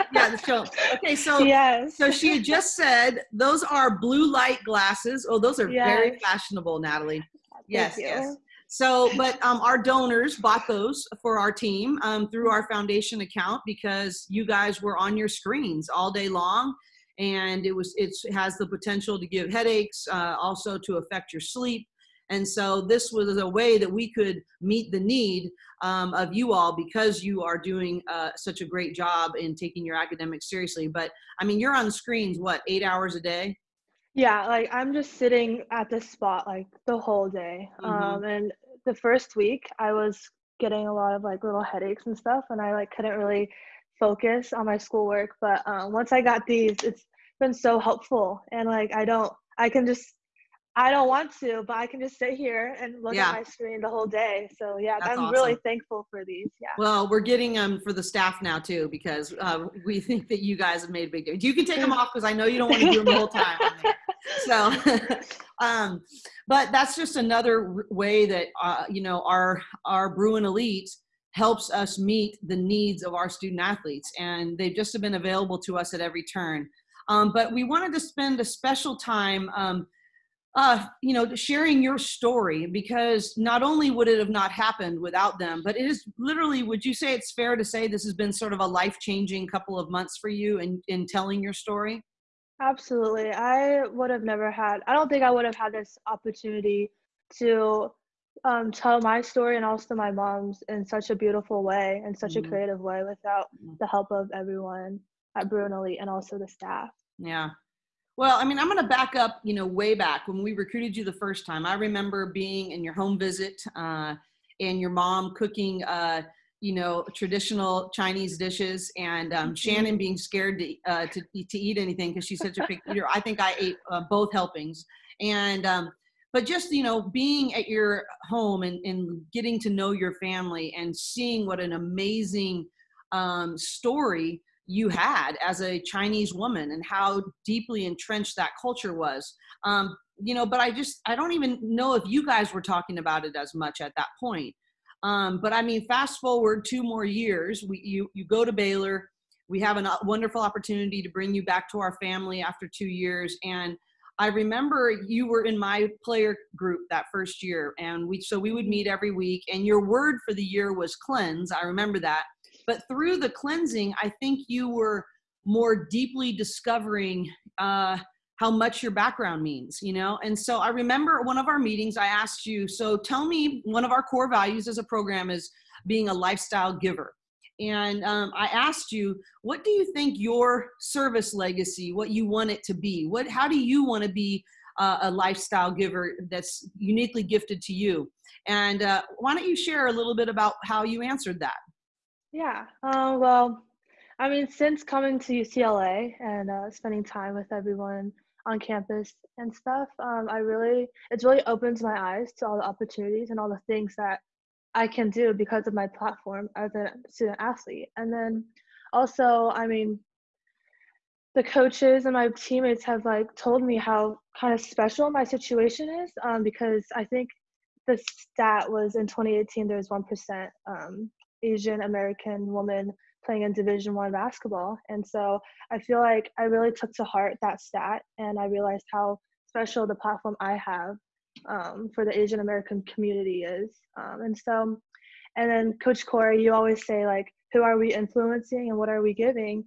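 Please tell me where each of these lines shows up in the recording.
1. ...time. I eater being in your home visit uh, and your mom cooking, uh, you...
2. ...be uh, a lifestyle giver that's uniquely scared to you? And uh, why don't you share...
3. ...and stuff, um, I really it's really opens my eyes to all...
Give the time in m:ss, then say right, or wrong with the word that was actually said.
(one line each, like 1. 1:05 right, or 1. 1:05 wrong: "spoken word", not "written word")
1. 1:51 wrong: "remember", not "eater"
2. 3:04 wrong: "gifted", not "scared"
3. 3:19 right.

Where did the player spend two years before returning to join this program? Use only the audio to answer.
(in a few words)
Baylor.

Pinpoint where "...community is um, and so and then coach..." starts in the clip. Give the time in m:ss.
3:52.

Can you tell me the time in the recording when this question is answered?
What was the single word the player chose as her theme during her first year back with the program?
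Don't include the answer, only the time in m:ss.
2:40.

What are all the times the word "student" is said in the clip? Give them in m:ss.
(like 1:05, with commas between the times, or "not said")
1:13, 3:27.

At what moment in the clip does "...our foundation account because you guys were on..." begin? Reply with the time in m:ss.
0:12.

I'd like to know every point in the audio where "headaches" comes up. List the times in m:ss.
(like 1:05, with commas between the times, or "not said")
0:19, 0:41.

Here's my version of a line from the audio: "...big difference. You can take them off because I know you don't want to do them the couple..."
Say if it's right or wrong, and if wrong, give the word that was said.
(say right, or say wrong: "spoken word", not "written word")
wrong: "whole", not "couple".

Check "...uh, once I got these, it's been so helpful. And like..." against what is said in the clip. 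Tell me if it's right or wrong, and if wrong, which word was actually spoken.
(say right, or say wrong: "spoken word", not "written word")
right.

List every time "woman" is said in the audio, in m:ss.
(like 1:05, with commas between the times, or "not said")
2:16, 3:42.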